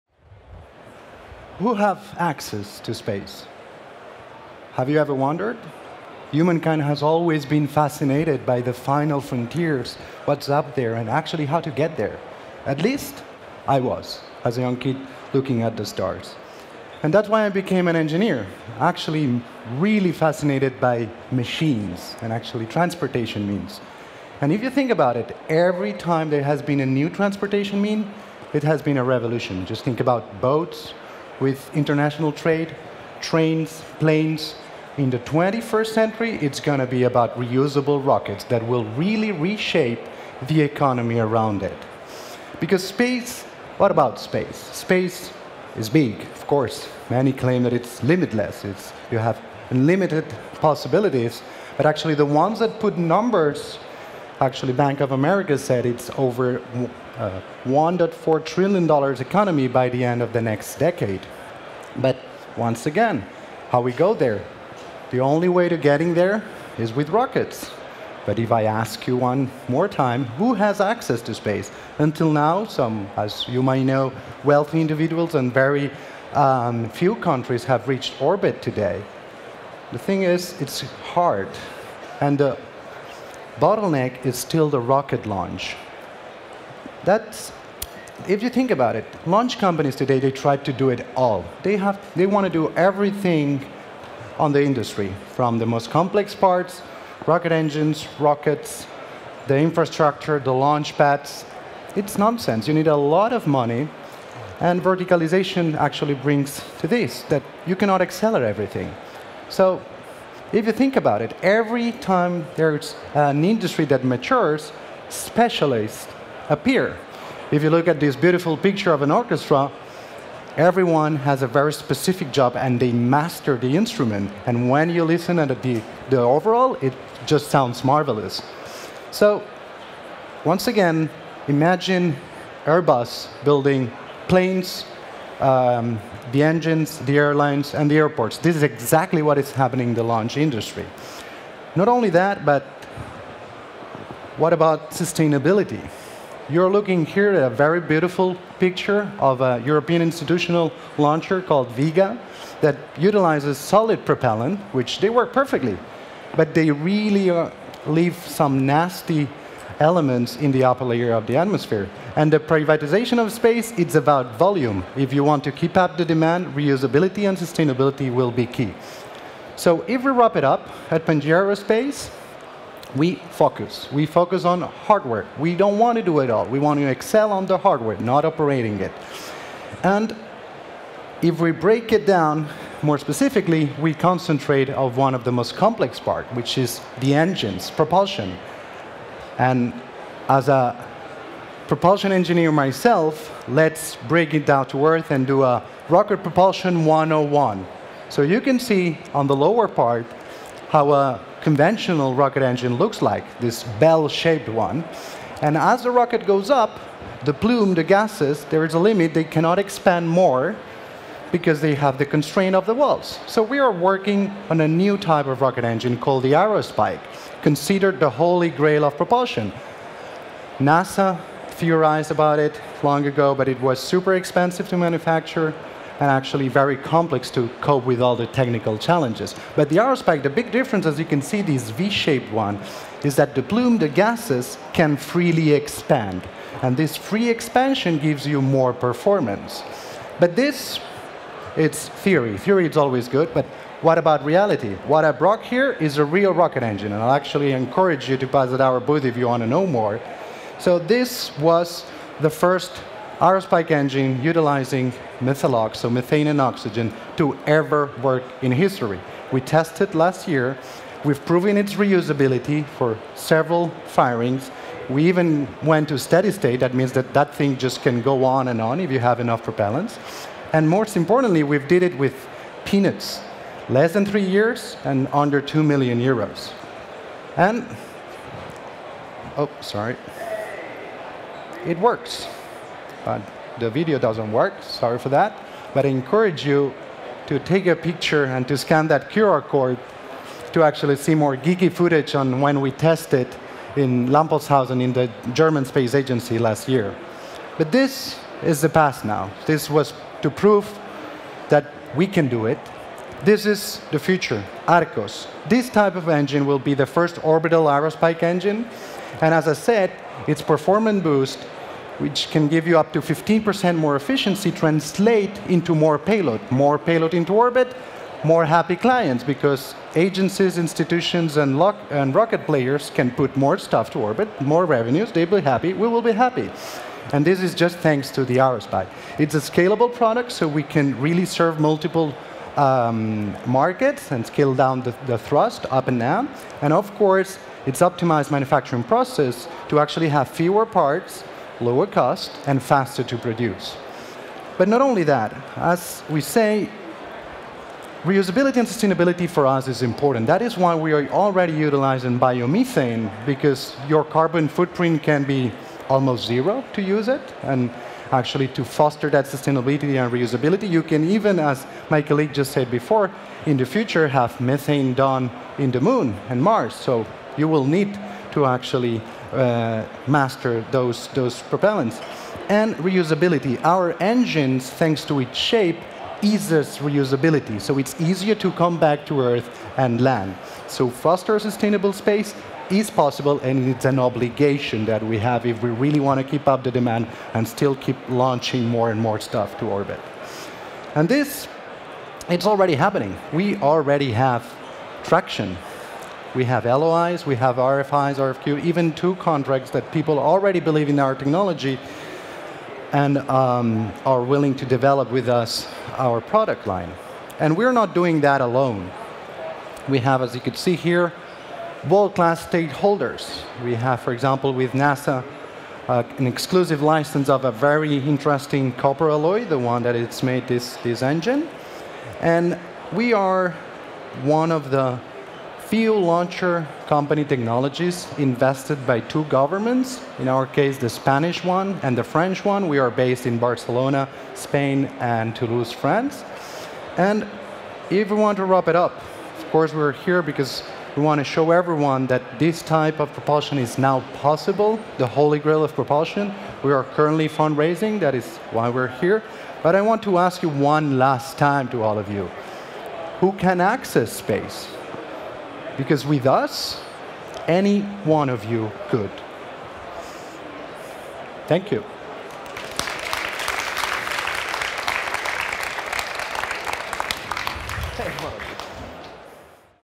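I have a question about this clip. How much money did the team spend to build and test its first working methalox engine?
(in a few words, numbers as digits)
under 2 million euros.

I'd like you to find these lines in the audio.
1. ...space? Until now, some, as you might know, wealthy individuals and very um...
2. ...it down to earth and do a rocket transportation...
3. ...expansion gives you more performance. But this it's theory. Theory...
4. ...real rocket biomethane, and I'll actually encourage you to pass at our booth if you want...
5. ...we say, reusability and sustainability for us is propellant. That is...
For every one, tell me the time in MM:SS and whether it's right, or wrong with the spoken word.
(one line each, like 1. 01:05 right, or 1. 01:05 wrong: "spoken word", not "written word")
1. 01:11 right
2. 03:14 wrong: "propulsion", not "transportation"
3. 03:57 right
4. 04:06 wrong: "engine", not "biomethane"
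5. 05:46 wrong: "important", not "propellant".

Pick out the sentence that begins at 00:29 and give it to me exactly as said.
Just think about boats, with international trade, trains, planes.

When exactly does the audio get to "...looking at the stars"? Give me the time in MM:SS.
00:15.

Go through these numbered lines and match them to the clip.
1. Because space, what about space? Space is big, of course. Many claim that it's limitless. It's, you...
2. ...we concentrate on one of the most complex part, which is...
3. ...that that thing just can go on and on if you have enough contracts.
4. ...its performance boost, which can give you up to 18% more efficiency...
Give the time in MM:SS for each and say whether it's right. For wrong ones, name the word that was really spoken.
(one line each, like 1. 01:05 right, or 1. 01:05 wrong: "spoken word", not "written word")
1. 00:42 right
2. 03:03 right
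3. 04:26 wrong: "propellants", not "contracts"
4. 05:10 wrong: "15", not "18".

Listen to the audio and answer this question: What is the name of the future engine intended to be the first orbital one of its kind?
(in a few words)
Arcos.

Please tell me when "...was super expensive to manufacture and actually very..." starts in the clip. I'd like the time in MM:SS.
03:43.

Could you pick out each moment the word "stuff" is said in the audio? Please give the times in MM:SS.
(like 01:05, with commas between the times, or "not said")
05:23, 06:29.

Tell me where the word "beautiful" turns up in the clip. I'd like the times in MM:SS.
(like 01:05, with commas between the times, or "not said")
01:58, 02:27.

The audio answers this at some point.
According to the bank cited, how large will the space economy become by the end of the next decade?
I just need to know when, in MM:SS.
00:57.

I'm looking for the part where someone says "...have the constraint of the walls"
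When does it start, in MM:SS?
03:31.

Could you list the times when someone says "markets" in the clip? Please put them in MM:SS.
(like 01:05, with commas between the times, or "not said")
05:33.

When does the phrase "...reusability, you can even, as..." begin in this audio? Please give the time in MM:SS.
06:00.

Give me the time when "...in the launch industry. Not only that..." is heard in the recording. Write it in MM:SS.
02:19.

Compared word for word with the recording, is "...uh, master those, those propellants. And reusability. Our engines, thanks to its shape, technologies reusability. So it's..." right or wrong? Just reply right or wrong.
wrong.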